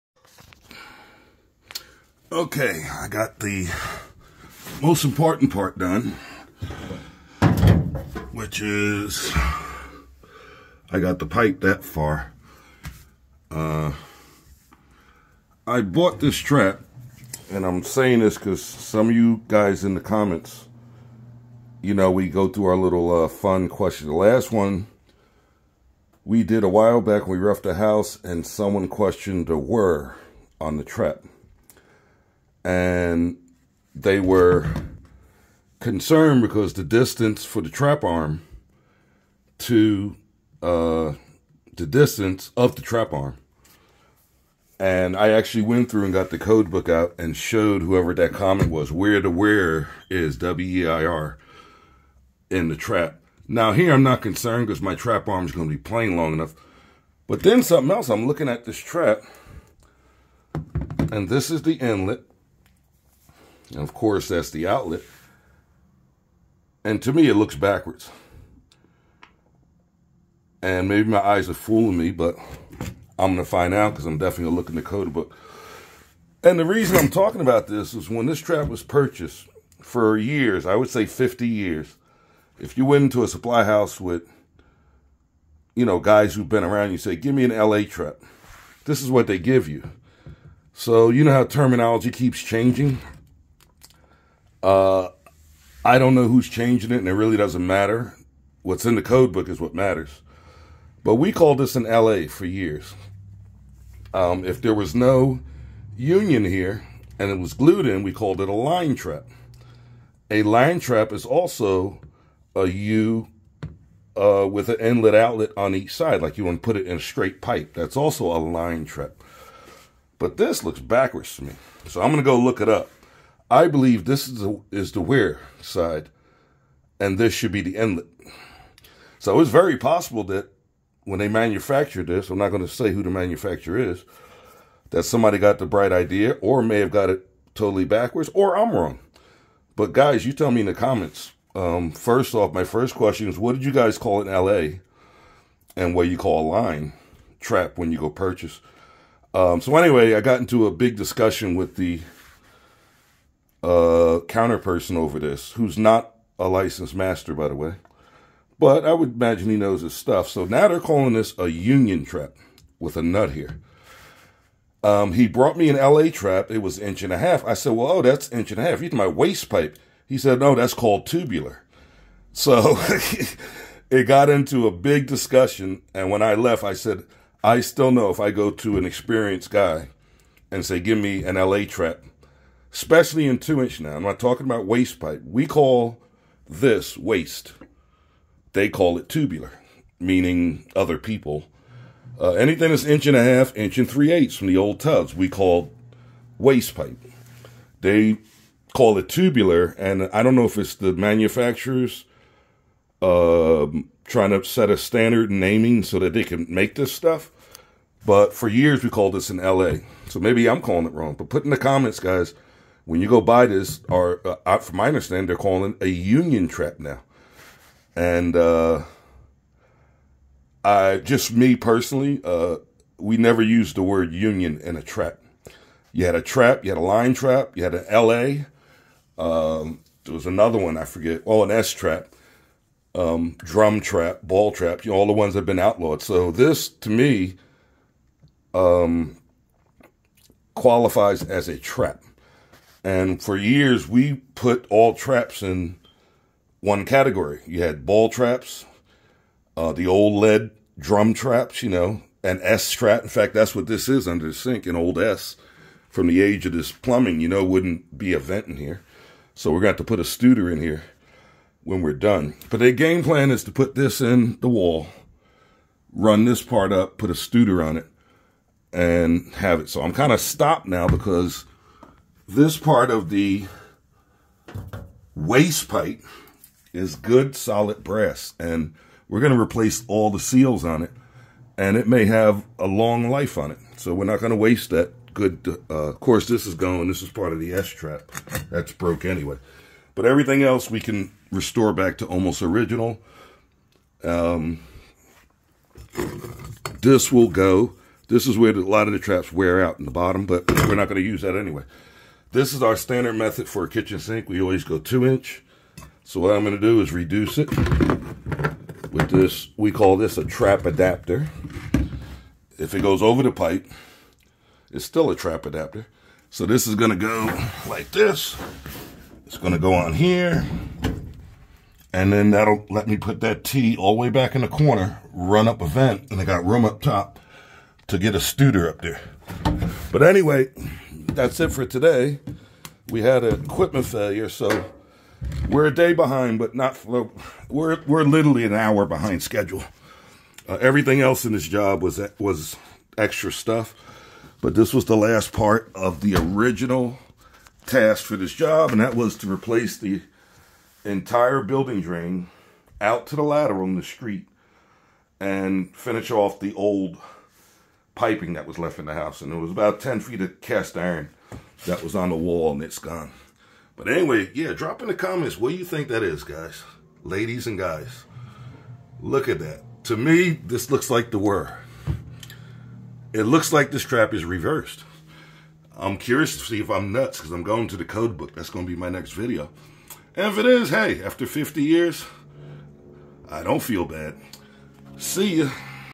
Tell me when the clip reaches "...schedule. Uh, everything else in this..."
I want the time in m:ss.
5:39.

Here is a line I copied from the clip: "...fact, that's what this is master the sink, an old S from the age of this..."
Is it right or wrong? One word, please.
wrong.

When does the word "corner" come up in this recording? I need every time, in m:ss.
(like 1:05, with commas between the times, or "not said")
5:24.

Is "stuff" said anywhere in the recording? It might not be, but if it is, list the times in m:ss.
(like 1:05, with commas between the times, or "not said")
2:39, 3:26, 5:43.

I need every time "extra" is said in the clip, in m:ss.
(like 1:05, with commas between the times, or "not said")
5:42.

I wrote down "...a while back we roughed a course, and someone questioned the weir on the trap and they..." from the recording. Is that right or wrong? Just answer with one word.
wrong.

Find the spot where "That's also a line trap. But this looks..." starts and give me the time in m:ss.
1:57.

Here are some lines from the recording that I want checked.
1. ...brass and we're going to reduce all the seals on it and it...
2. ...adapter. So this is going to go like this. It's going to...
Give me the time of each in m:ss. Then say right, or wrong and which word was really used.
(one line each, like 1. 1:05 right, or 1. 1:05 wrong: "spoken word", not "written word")
1. 4:37 wrong: "replace", not "reduce"
2. 5:15 right.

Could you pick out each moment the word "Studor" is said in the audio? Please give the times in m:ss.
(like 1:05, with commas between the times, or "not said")
4:20, 4:27, 5:28.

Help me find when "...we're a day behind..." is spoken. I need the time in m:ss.
5:35.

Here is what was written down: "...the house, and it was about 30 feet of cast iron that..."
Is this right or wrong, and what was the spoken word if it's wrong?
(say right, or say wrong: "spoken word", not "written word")
wrong: "10", not "30".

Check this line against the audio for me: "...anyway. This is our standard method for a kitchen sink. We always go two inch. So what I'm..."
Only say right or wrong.
right.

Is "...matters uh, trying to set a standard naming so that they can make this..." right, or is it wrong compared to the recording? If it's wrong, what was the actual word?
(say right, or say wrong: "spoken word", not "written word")
wrong: "manufacturers", not "matters".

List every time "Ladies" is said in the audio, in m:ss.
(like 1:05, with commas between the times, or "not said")
6:07.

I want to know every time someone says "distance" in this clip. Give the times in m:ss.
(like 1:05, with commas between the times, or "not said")
0:36, 0:41.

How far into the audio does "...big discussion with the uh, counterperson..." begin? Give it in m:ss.
2:30.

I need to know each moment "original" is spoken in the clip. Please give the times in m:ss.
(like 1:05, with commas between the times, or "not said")
4:52, 5:46.